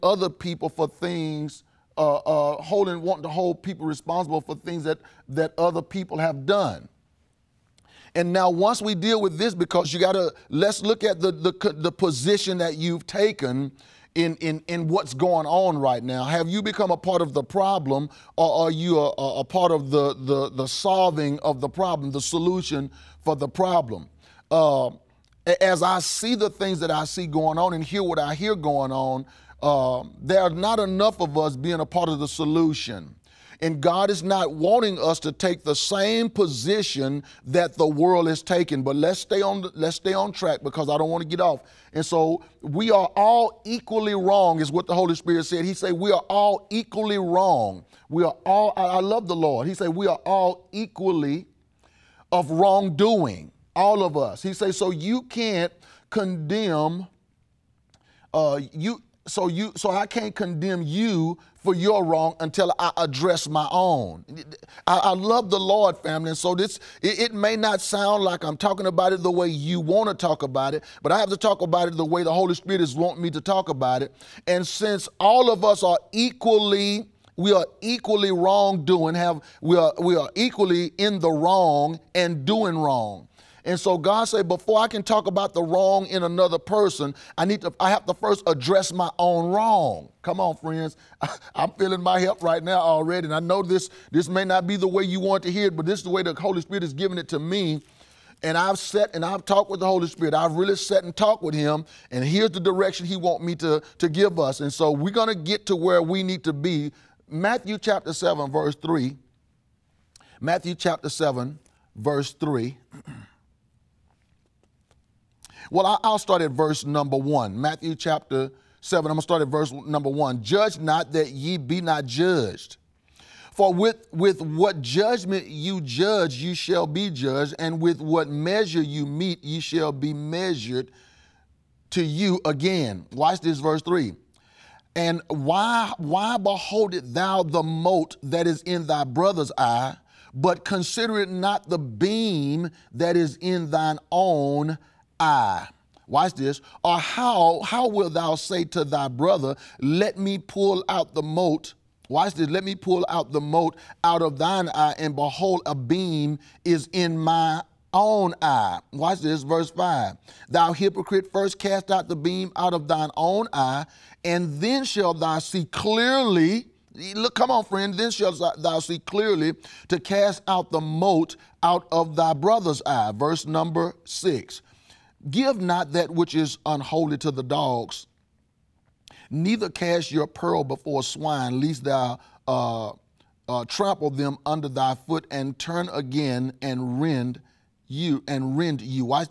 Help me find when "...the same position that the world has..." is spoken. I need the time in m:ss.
0:35.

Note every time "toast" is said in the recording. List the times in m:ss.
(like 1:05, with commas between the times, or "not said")
not said.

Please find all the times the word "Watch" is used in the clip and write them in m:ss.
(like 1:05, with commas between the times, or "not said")
2:13, 2:26, 2:32, 2:38.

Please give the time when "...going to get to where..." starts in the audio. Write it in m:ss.
1:45.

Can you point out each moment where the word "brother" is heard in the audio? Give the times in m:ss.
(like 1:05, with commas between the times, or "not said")
2:19, 2:29, 2:52.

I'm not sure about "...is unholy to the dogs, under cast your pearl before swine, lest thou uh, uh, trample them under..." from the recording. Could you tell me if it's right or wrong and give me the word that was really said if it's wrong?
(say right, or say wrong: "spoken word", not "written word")
wrong: "neither", not "under".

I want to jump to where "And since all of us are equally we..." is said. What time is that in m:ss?
1:14.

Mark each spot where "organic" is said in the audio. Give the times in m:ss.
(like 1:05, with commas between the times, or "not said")
not said.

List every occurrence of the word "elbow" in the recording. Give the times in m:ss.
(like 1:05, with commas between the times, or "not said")
not said.